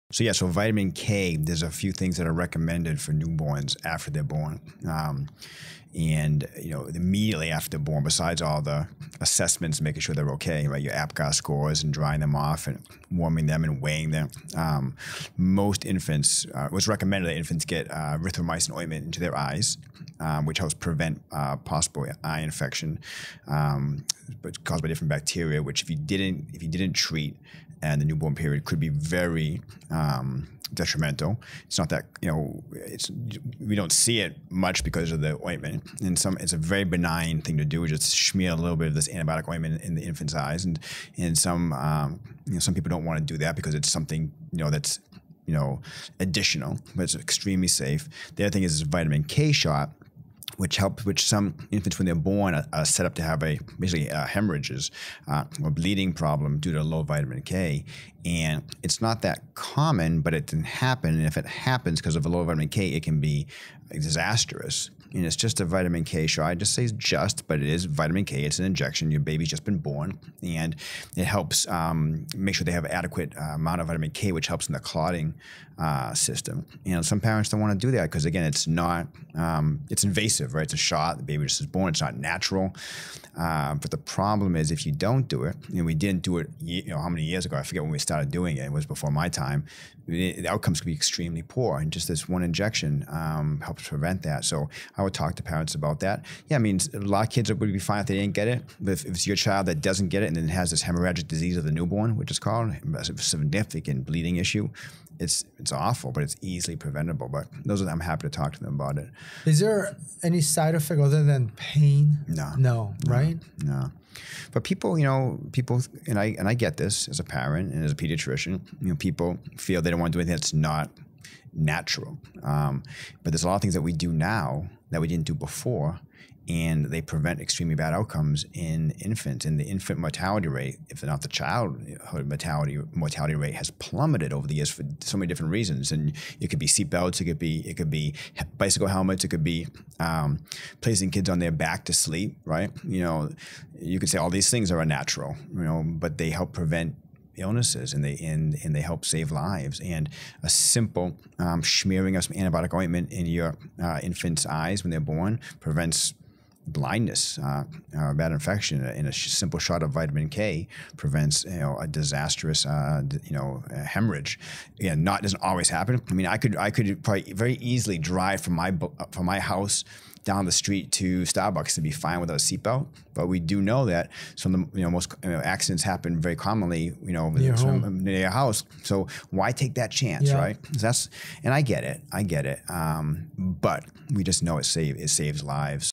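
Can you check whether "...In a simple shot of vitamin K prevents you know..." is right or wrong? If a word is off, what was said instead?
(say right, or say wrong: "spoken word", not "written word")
right.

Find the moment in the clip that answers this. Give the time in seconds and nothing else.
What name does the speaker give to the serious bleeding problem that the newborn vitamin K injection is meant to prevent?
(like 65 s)
100 s.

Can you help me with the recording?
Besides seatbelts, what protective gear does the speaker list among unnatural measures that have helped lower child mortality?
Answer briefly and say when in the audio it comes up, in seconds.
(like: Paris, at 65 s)
bicycle helmets, at 138 s.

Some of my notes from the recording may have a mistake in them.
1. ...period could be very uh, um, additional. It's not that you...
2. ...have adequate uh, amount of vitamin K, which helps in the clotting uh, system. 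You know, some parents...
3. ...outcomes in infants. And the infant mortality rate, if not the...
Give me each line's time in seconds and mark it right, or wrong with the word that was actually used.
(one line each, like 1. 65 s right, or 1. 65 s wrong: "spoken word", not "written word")
1. 28 s wrong: "detrimental", not "additional"
2. 72 s right
3. 127 s right.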